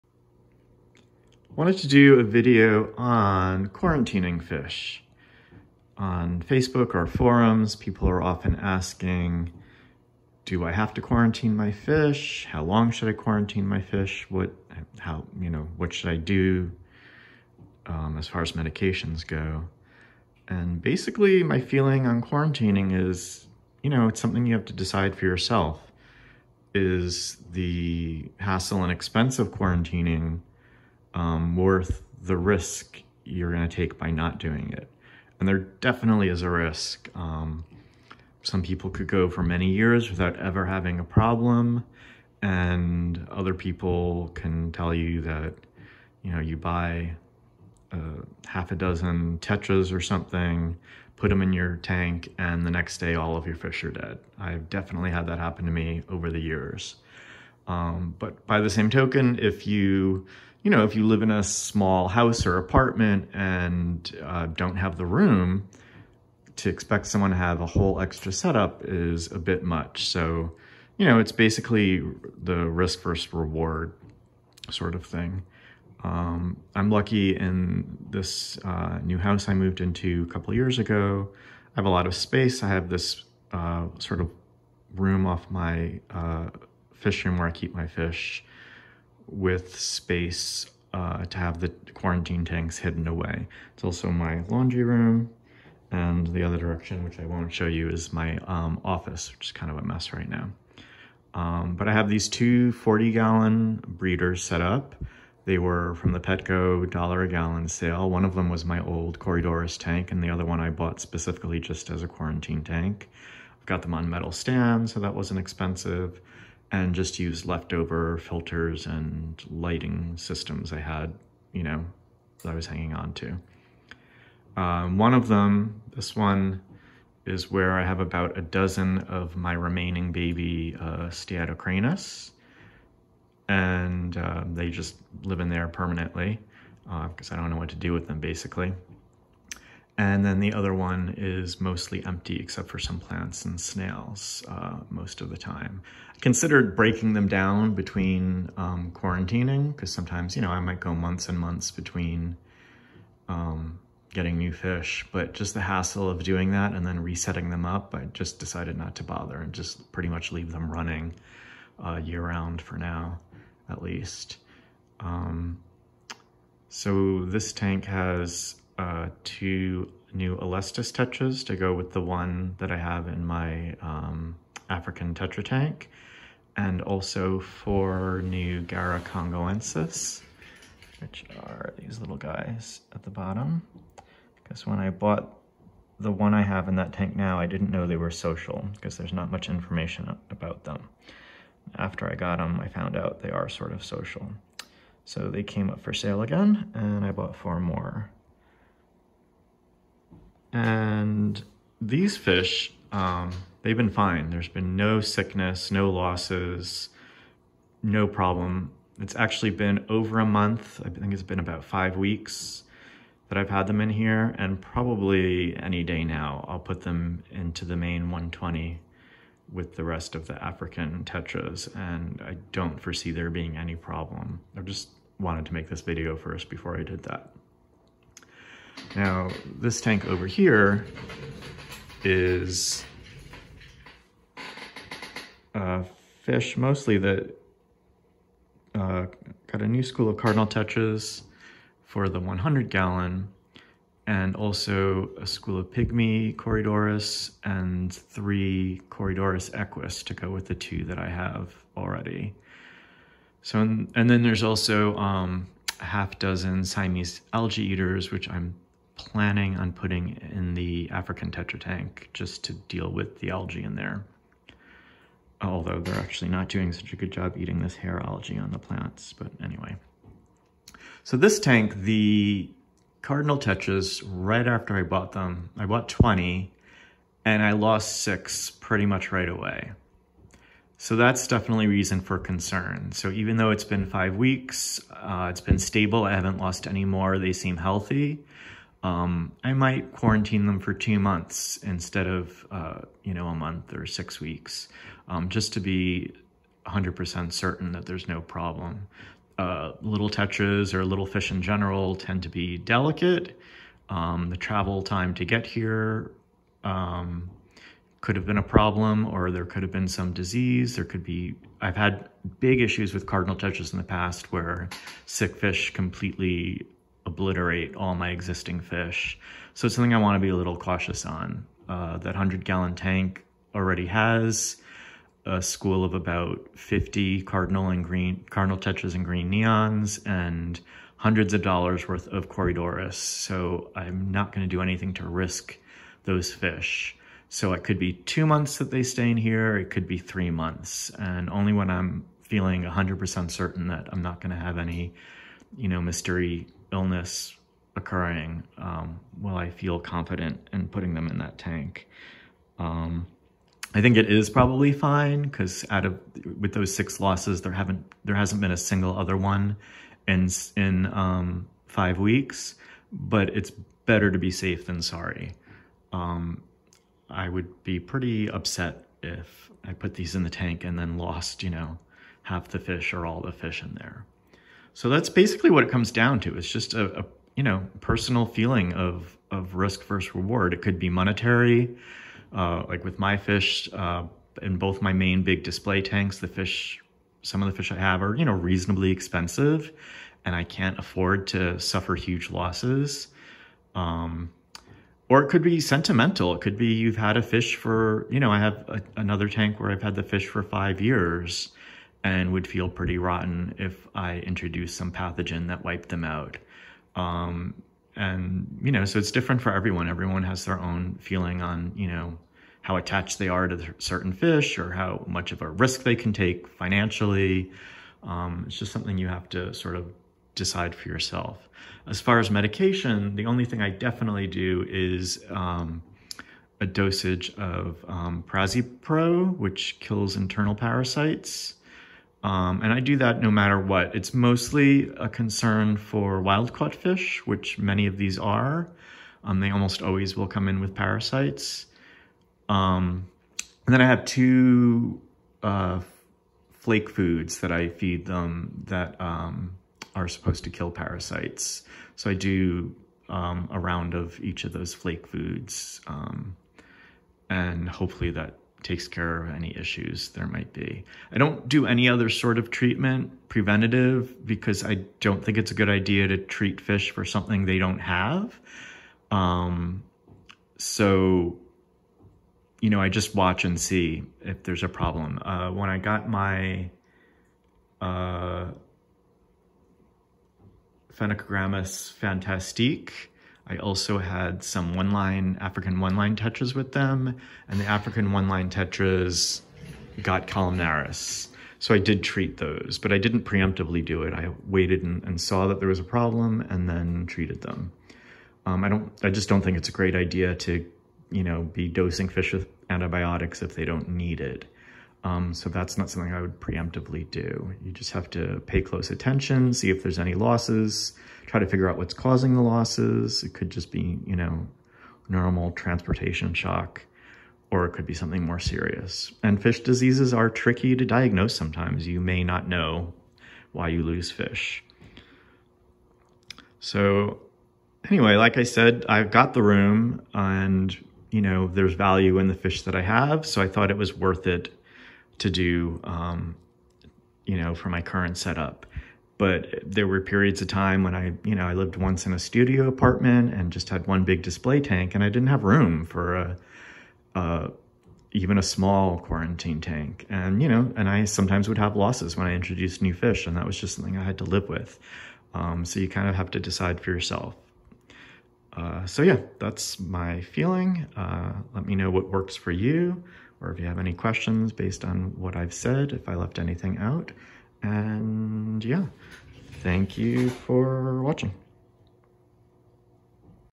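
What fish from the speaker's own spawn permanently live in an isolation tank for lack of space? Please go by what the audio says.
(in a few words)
Steatocranus.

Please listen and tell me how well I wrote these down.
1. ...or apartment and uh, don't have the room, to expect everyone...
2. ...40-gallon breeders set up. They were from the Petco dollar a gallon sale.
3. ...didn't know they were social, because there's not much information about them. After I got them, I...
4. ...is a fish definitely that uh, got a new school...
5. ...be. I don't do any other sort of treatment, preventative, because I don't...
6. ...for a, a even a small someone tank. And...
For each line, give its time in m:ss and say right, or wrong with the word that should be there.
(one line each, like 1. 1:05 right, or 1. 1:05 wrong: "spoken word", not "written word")
1. 1:02 wrong: "someone", not "everyone"
2. 1:42 right
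3. 3:07 right
4. 3:52 wrong: "mostly", not "definitely"
5. 7:40 right
6. 9:05 wrong: "quarantine", not "someone".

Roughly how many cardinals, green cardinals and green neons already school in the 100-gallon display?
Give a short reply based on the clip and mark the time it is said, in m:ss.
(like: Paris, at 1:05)
about 50, at 5:25.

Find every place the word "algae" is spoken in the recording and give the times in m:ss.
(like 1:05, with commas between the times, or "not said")
4:17, 4:23, 4:28.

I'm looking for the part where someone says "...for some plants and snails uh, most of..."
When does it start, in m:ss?
2:22.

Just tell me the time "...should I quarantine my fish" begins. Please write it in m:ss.
0:12.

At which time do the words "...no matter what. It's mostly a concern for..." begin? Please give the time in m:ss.
7:13.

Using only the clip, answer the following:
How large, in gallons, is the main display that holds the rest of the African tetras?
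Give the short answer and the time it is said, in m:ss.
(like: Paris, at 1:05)
120, at 3:38.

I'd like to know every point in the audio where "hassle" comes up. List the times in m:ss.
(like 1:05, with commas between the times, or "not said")
0:28, 2:35.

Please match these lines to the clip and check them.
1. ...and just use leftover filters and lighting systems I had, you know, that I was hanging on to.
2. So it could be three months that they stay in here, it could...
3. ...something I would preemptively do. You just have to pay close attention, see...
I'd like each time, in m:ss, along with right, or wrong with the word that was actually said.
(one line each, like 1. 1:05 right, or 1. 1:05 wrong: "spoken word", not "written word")
1. 1:56 right
2. 5:37 wrong: "two", not "three"
3. 8:25 right.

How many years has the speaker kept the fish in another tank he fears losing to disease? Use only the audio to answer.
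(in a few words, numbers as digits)
5.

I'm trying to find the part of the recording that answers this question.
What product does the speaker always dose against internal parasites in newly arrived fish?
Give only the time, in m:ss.
7:08.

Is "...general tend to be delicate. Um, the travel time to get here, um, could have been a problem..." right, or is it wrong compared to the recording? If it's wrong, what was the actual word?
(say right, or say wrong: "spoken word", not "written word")
right.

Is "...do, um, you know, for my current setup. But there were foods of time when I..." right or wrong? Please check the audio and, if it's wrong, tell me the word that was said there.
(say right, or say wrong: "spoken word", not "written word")
wrong: "periods", not "foods".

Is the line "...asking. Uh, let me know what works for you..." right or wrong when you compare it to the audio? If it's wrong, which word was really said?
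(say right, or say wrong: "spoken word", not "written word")
wrong: "feeling", not "asking".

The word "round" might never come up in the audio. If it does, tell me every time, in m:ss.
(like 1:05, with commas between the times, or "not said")
2:42, 7:33.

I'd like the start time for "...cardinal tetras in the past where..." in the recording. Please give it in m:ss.
5:13.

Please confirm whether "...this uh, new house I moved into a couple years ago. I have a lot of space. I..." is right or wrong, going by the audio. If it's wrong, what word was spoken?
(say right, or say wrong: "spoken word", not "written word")
right.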